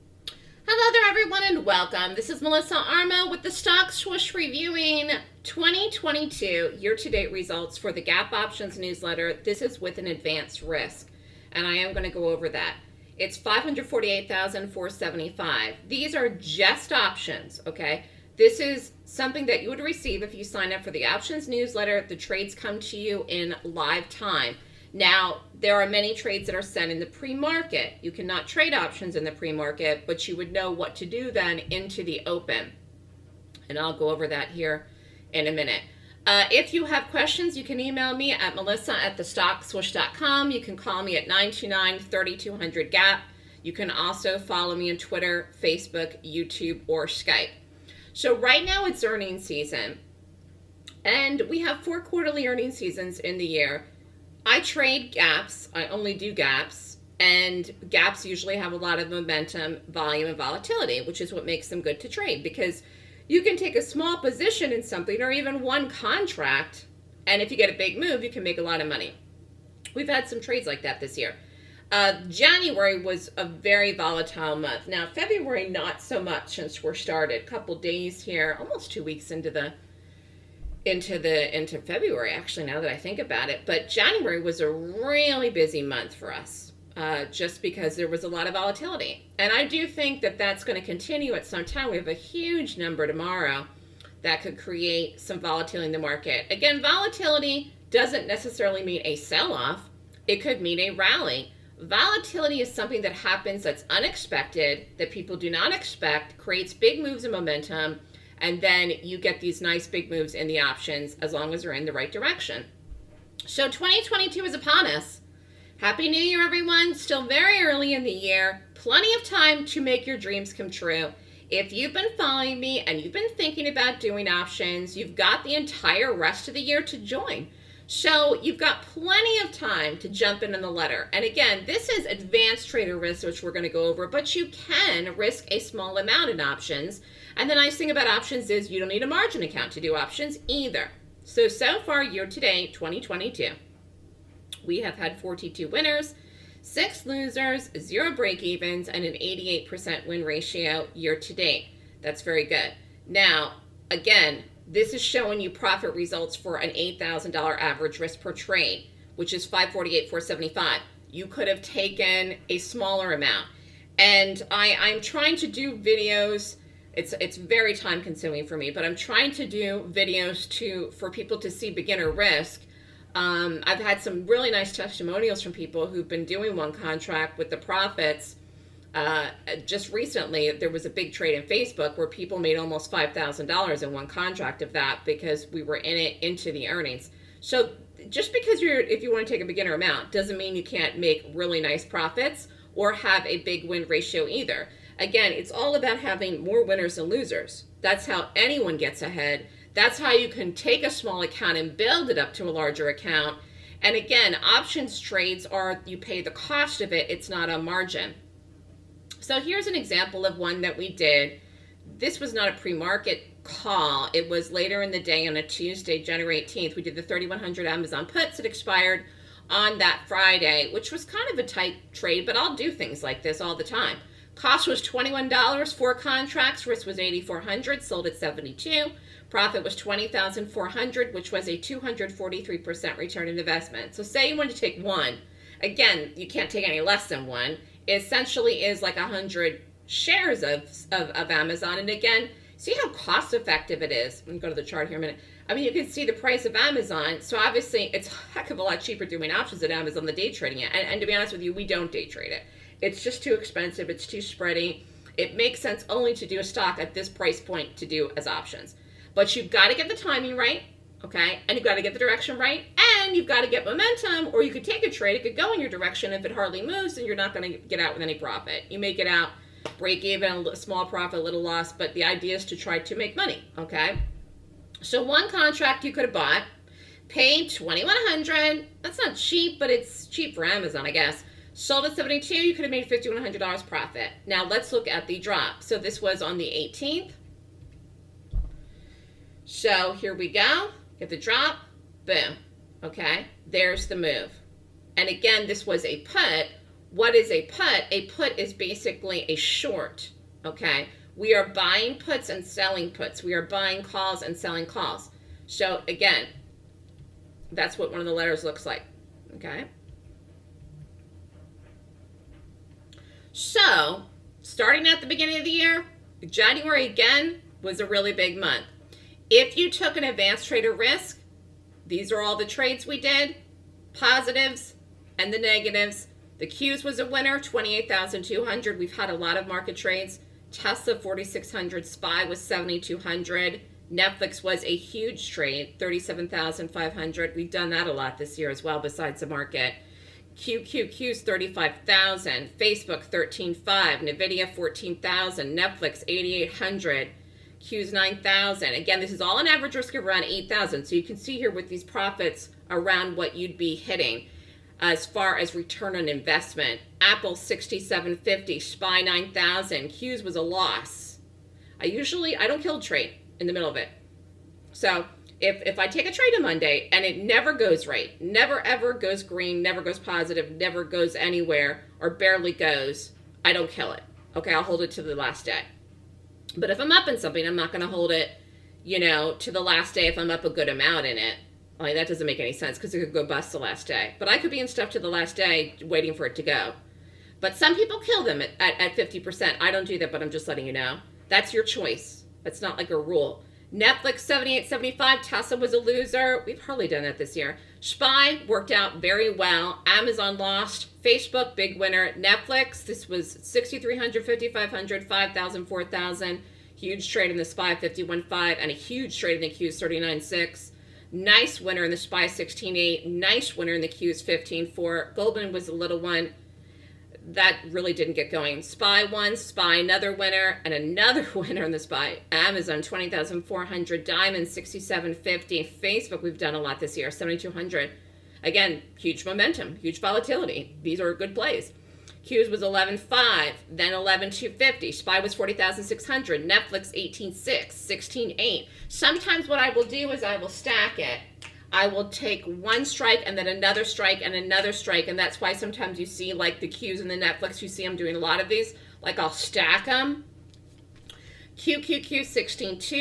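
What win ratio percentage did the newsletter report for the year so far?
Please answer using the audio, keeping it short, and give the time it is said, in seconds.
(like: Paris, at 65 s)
88%, at 149 s.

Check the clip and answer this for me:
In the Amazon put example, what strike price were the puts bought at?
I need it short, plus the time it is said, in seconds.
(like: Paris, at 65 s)
3100, at 217 s.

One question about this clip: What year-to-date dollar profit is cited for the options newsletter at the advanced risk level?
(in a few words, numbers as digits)
548,475.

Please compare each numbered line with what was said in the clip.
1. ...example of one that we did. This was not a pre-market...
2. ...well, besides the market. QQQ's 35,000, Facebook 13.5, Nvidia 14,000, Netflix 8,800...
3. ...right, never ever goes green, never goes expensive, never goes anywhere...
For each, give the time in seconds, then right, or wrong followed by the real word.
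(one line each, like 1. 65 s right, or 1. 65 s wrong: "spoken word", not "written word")
1. 209 s right
2. 338 s right
3. 367 s wrong: "positive", not "expensive".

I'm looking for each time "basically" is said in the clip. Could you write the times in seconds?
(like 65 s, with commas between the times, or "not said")
298 s.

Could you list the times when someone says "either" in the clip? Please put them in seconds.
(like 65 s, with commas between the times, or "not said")
140 s, 194 s.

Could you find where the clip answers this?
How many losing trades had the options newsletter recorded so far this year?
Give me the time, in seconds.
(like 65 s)
146 s.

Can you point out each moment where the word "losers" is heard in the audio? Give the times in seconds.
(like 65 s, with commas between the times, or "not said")
147 s, 197 s, 395 s.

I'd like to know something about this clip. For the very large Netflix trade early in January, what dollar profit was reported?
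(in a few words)
37,500.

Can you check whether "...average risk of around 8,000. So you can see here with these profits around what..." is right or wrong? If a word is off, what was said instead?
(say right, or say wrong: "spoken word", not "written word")
right.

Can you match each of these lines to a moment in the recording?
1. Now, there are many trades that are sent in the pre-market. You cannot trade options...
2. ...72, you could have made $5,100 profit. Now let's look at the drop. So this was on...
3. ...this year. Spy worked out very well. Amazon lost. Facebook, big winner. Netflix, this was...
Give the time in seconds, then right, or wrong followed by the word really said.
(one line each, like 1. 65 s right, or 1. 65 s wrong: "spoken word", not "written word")
1. 24 s right
2. 281 s right
3. 397 s right.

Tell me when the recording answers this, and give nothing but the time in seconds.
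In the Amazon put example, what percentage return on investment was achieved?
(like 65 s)
231 s.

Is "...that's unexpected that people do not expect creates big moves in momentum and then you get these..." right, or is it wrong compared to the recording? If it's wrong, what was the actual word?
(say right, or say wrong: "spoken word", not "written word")
right.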